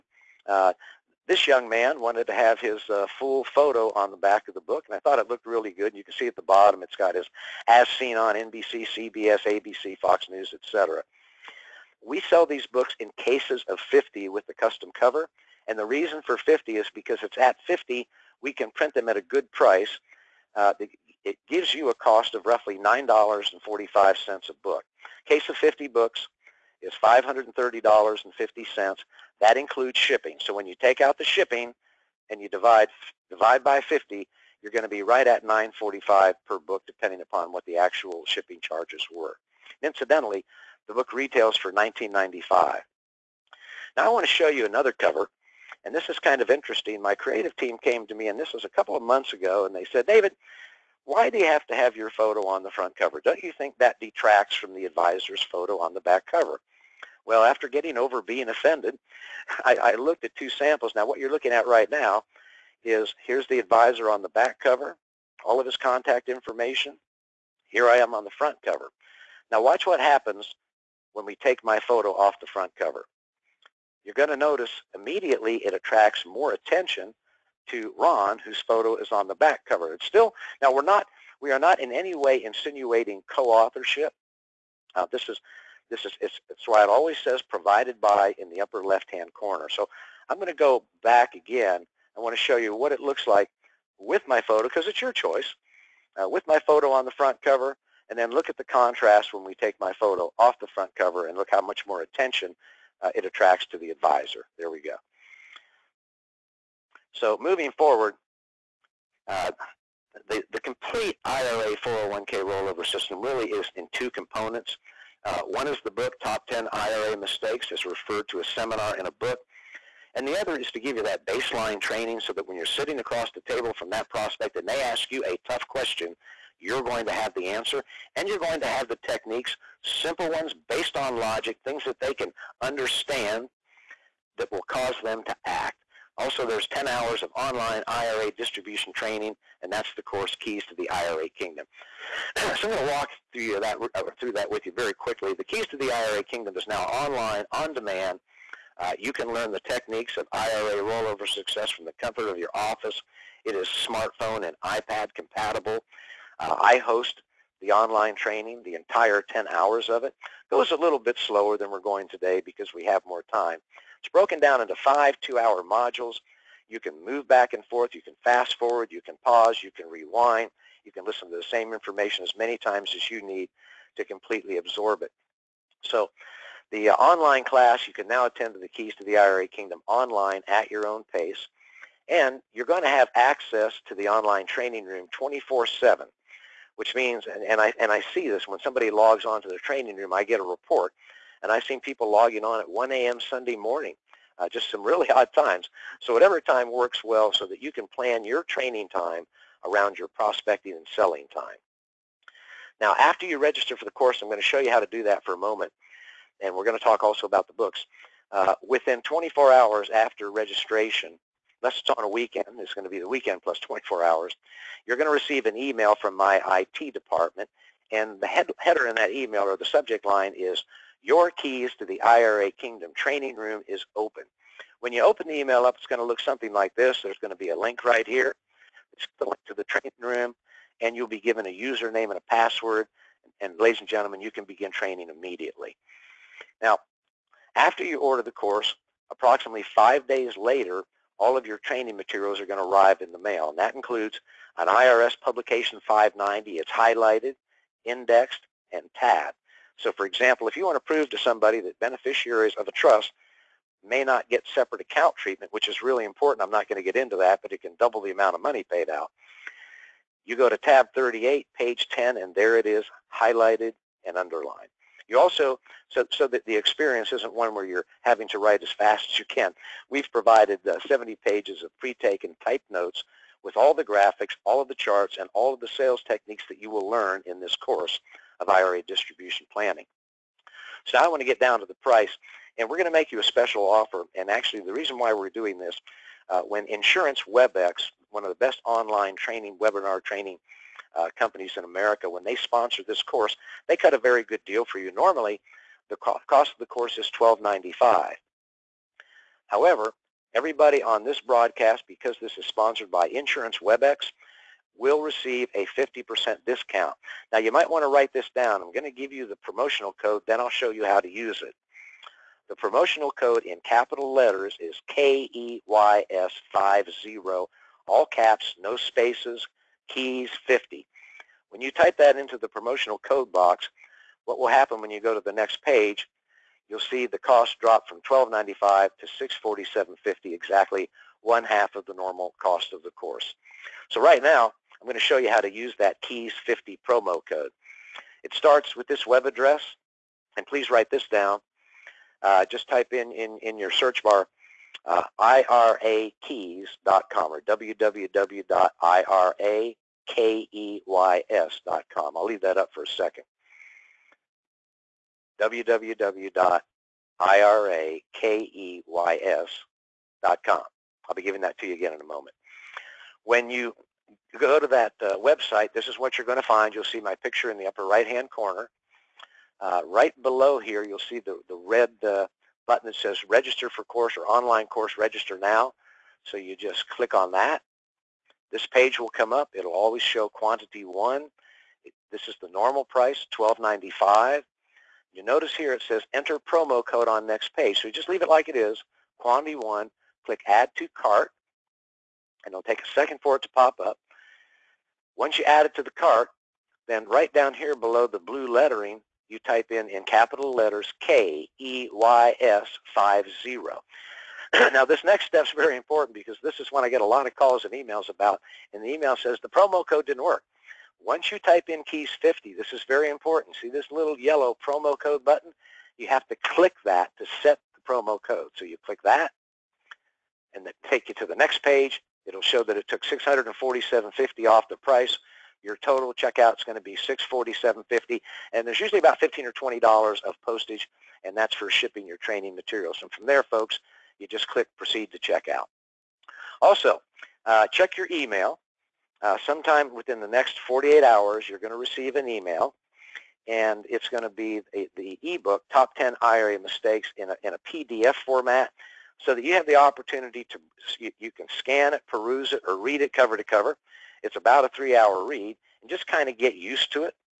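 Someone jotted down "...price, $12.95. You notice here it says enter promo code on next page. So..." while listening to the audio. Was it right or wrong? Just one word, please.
right.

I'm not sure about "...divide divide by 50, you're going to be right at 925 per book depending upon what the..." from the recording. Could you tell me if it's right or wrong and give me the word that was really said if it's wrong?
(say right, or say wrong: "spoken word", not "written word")
wrong: "945", not "925".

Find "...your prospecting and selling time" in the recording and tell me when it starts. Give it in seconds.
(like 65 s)
199 s.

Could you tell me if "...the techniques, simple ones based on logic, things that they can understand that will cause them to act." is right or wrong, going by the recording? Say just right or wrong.
right.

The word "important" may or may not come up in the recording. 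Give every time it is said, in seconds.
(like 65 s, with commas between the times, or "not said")
256 s, 405 s, 413 s.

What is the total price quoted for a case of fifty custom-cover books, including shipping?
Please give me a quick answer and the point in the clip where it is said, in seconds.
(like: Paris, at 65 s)
$530.50, at 27 s.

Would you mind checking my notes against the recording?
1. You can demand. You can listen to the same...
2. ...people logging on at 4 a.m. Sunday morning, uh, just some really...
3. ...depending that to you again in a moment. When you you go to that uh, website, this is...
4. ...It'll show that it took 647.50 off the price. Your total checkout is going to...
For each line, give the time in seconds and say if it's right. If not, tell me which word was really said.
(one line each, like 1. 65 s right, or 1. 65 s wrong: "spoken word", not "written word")
1. 169 s wrong: "rewind", not "demand"
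2. 191 s wrong: "1", not "4"
3. 361 s wrong: "giving", not "depending"
4. 422 s right.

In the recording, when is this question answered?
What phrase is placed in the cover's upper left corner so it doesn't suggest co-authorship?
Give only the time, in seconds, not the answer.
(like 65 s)
87 s.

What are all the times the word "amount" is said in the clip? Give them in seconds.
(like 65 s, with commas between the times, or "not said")
258 s.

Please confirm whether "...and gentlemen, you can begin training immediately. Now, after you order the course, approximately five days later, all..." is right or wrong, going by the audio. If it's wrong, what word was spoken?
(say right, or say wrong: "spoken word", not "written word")
right.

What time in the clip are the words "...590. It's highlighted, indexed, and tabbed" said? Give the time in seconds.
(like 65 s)
245 s.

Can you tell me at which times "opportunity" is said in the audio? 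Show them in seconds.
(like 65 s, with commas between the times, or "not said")
449 s.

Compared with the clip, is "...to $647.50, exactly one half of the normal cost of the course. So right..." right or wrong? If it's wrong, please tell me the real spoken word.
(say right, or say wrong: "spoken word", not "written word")
right.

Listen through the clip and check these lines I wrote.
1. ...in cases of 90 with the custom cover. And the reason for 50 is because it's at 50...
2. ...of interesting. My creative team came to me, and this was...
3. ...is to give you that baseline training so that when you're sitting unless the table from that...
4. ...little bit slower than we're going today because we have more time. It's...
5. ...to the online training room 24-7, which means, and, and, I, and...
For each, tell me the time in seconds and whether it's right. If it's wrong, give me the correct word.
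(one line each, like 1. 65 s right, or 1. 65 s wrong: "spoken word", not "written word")
1. 13 s wrong: "50", not "90"
2. 46 s right
3. 120 s wrong: "across", not "unless"
4. 160 s right
5. 183 s right.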